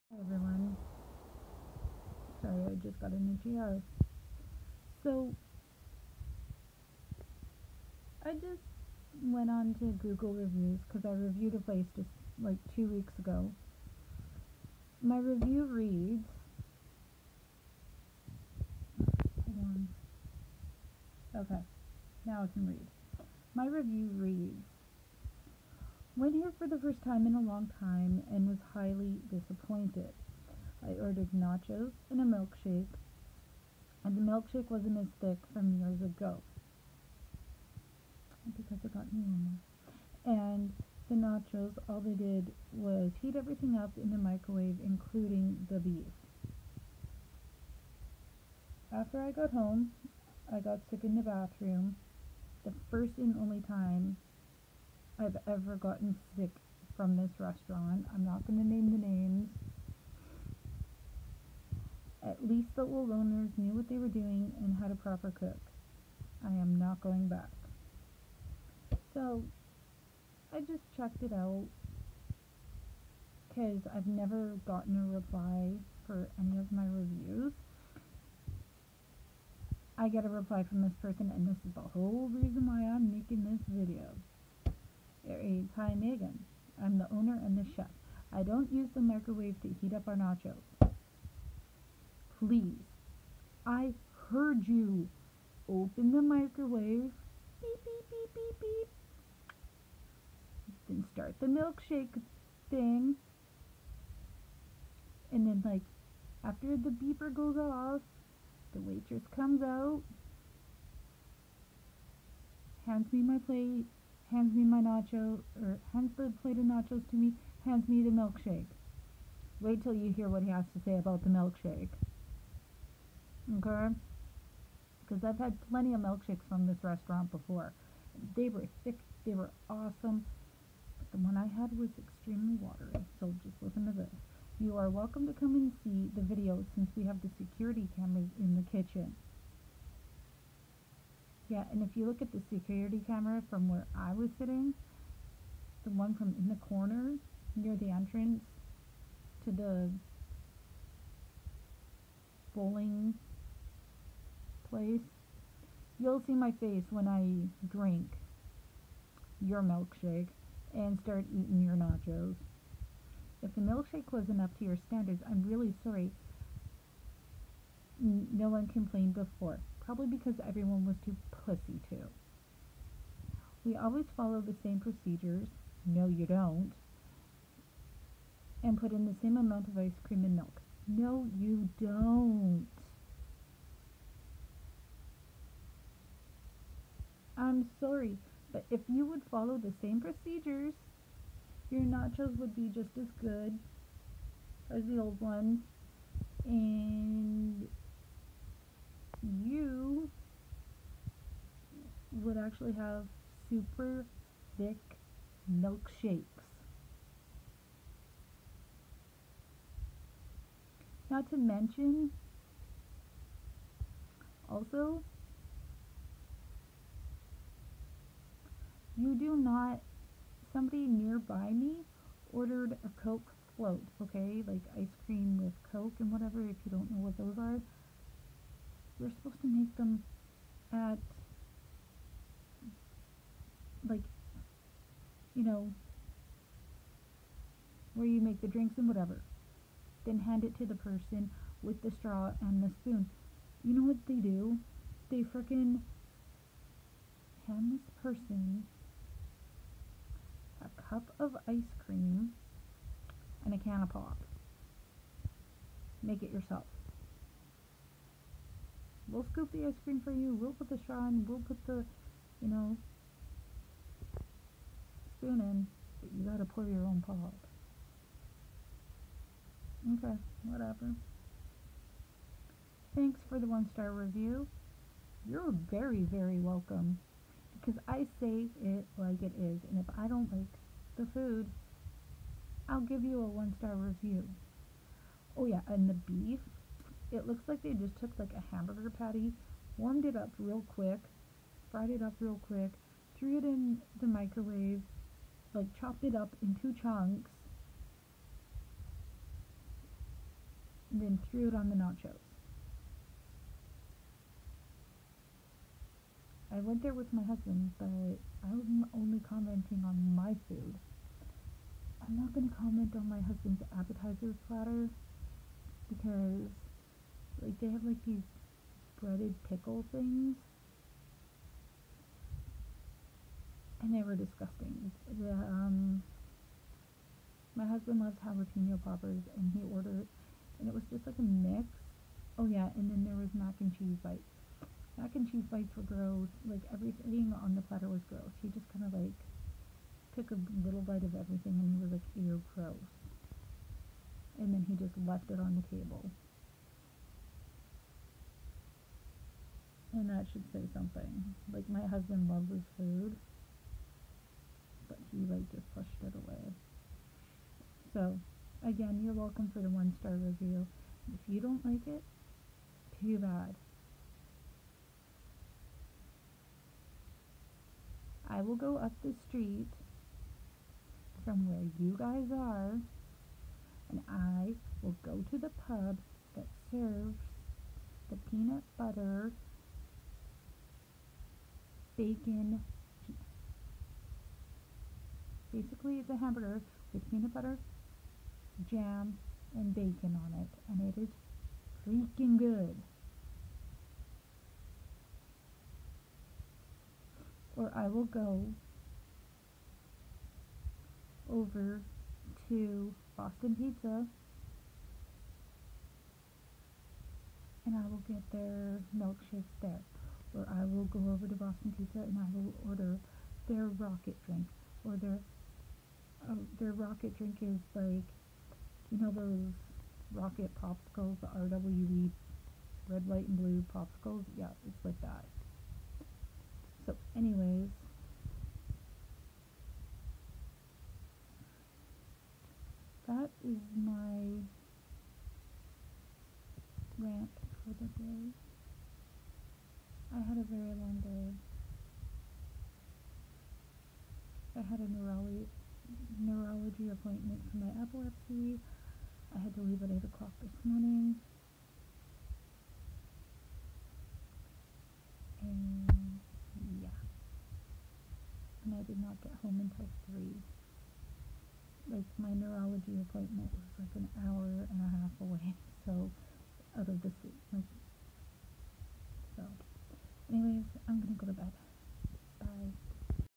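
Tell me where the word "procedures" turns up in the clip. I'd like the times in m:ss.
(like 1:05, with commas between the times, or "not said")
2:54, 3:09.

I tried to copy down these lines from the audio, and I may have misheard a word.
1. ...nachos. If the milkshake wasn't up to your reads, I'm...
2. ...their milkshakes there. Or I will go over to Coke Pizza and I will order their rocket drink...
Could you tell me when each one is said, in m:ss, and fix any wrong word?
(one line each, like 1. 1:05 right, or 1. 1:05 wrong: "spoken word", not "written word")
1. 2:41 wrong: "standards", not "reads"
2. 6:48 wrong: "Boston", not "Coke".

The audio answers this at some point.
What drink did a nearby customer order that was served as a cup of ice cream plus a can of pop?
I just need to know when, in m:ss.
3:43.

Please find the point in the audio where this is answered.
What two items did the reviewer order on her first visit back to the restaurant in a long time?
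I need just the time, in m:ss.
0:31.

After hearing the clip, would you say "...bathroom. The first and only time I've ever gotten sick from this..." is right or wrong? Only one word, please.
right.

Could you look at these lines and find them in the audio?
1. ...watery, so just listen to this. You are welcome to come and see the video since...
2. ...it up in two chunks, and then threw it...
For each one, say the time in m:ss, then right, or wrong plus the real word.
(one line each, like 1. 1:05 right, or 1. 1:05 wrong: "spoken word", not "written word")
1. 2:12 right
2. 4:56 right.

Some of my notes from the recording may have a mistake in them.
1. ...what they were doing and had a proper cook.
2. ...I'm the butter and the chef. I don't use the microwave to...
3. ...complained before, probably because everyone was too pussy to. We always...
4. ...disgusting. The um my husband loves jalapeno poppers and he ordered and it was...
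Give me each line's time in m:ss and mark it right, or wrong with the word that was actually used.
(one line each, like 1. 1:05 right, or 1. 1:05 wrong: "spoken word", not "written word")
1. 1:03 right
2. 1:26 wrong: "owner", not "butter"
3. 2:48 right
4. 5:24 right.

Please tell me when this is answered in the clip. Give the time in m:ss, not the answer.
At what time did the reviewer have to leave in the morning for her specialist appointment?
7:29.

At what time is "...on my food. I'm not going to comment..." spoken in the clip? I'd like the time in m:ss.
5:09.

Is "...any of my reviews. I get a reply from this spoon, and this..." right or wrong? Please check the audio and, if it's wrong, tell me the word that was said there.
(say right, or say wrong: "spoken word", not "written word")
wrong: "person", not "spoon".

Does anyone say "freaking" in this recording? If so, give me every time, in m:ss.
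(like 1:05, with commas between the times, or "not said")
6:31.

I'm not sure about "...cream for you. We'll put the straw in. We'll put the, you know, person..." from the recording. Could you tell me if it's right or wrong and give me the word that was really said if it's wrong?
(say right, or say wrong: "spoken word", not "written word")
wrong: "spoon", not "person".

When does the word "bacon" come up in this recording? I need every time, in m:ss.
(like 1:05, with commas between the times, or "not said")
6:21, 6:29.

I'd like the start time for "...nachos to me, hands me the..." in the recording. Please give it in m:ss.
1:56.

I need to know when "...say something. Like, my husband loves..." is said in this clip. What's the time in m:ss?
5:50.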